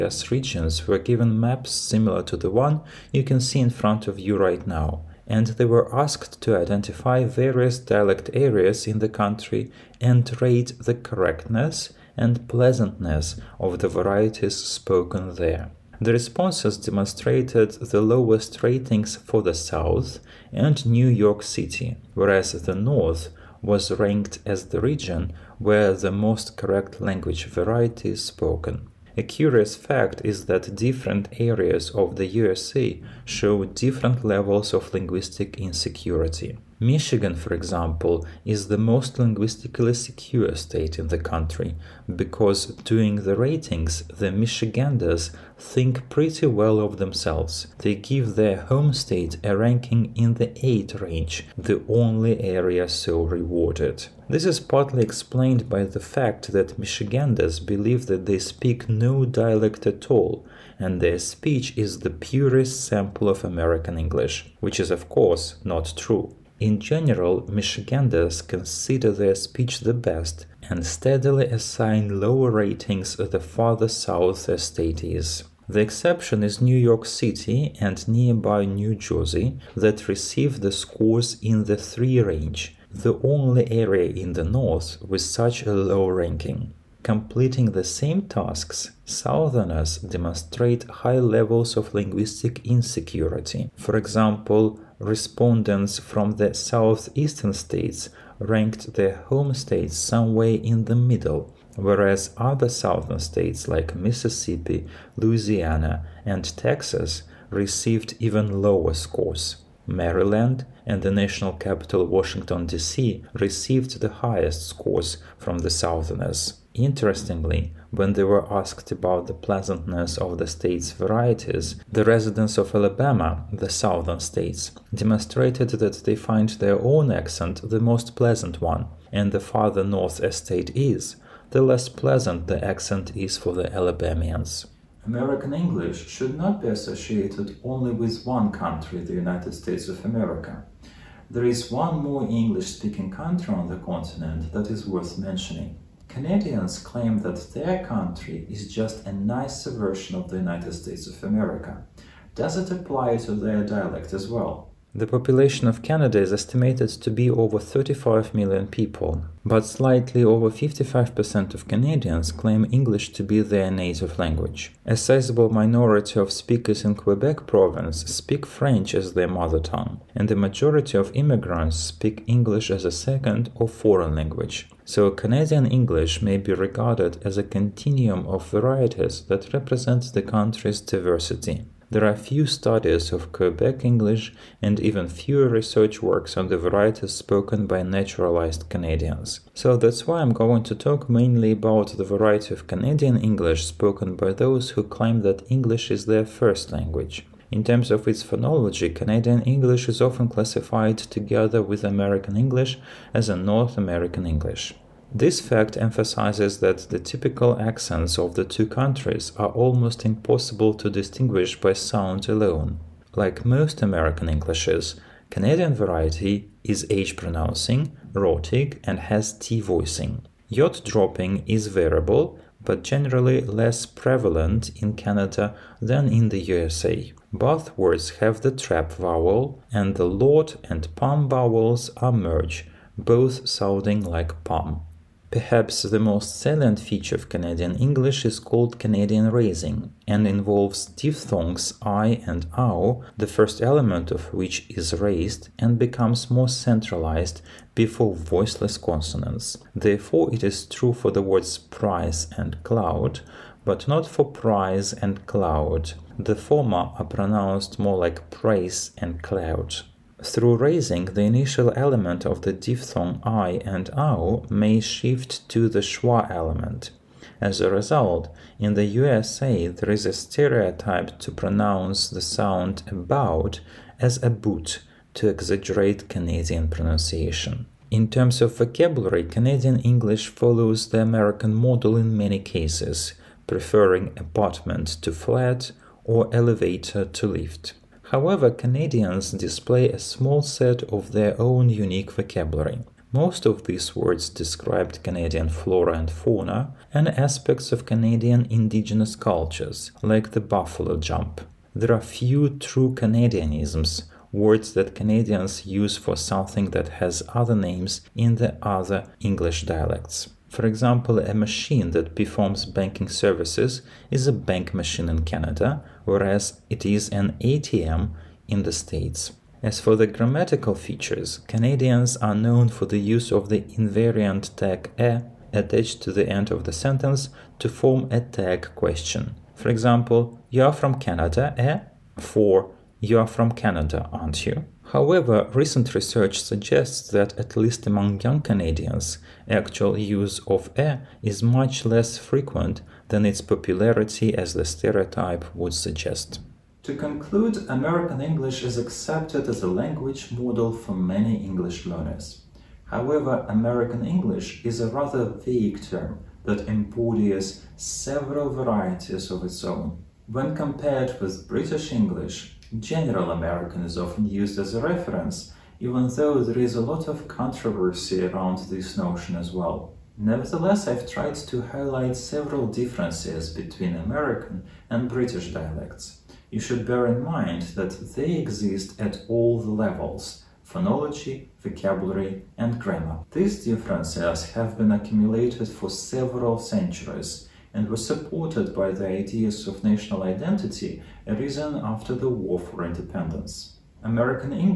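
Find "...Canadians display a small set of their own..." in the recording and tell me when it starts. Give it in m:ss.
4:48.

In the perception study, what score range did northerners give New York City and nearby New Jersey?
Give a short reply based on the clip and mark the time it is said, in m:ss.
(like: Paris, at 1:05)
3 range, at 1:21.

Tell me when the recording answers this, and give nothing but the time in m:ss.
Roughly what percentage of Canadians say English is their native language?
2:40.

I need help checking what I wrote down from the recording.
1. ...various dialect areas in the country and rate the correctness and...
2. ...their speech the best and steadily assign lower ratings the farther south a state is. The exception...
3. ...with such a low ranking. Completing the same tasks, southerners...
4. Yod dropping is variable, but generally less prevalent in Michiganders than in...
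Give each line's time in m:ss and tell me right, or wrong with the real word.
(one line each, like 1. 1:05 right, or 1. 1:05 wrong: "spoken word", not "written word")
1. 0:07 right
2. 1:09 right
3. 1:25 right
4. 3:40 wrong: "Canada", not "Michiganders".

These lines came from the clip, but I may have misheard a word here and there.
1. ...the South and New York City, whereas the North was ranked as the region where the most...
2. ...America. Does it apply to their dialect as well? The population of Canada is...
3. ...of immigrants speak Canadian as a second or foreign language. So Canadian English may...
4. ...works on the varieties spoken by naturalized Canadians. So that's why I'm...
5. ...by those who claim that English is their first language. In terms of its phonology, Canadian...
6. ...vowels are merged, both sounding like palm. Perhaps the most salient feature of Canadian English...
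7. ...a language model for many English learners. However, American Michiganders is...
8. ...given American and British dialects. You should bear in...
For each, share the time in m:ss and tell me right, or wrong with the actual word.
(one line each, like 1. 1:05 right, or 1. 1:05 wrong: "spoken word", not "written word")
1. 0:19 right
2. 2:31 right
3. 2:50 wrong: "English", not "Canadian"
4. 3:06 right
5. 3:14 right
6. 3:51 right
7. 5:49 wrong: "English", not "Michiganders"
8. 6:13 wrong: "between", not "given".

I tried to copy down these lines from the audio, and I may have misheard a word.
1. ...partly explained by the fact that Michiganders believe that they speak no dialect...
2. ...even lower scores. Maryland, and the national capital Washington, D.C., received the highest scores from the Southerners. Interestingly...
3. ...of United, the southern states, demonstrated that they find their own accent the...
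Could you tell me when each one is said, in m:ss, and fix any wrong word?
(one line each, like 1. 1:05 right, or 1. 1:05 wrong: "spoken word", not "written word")
1. 0:54 right
2. 1:48 right
3. 2:02 wrong: "Alabama", not "United".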